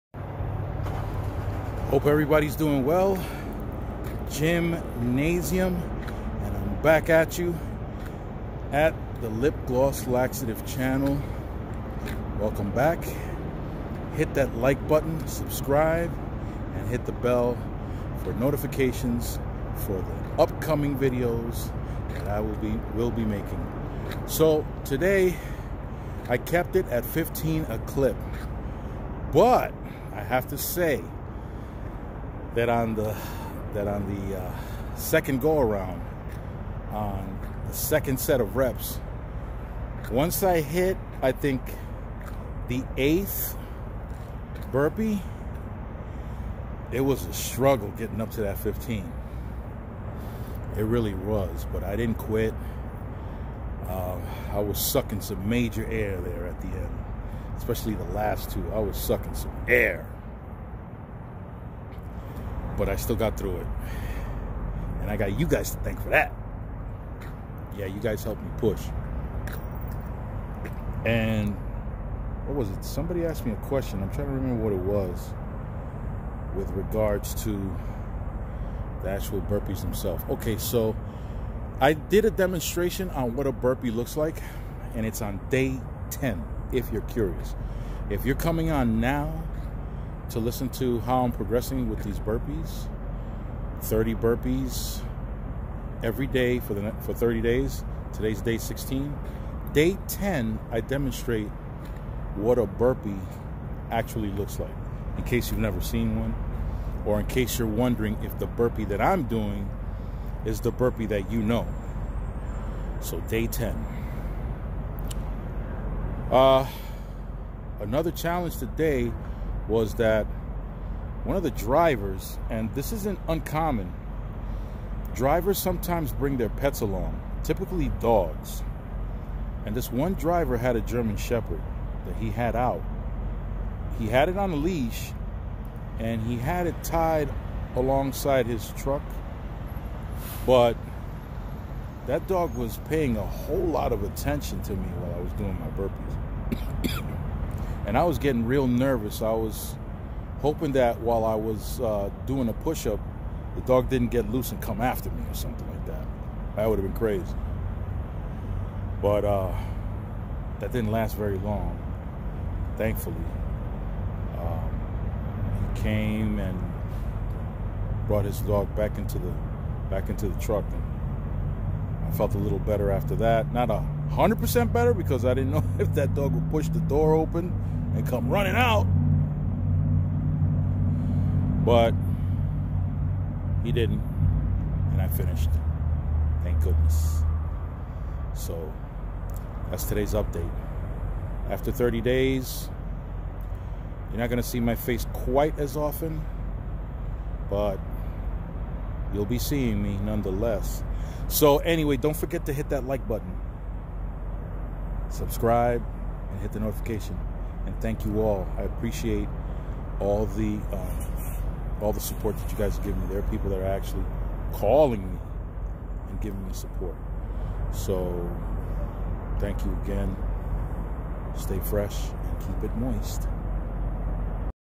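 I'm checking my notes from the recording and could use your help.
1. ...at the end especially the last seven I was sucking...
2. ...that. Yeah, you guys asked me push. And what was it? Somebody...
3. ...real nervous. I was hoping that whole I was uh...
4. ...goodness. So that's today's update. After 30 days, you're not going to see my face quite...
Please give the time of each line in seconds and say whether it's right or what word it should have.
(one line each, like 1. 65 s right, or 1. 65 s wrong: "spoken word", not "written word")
1. 56 s wrong: "two", not "seven"
2. 66 s wrong: "helped", not "asked"
3. 148 s wrong: "while", not "whole"
4. 186 s right.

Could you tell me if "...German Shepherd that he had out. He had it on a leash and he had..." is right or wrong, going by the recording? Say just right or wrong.
right.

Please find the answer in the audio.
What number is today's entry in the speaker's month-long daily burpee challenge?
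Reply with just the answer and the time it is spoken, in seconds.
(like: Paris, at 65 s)
16, at 98 s.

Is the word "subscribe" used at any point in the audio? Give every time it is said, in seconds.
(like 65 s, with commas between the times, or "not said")
15 s, 205 s.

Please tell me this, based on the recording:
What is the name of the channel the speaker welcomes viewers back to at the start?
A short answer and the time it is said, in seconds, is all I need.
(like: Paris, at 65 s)
Lip Gloss Laxative, at 9 s.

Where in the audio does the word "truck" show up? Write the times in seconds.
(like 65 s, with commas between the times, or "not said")
138 s, 170 s.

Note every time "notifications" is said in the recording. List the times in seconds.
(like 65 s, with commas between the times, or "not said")
18 s, 206 s.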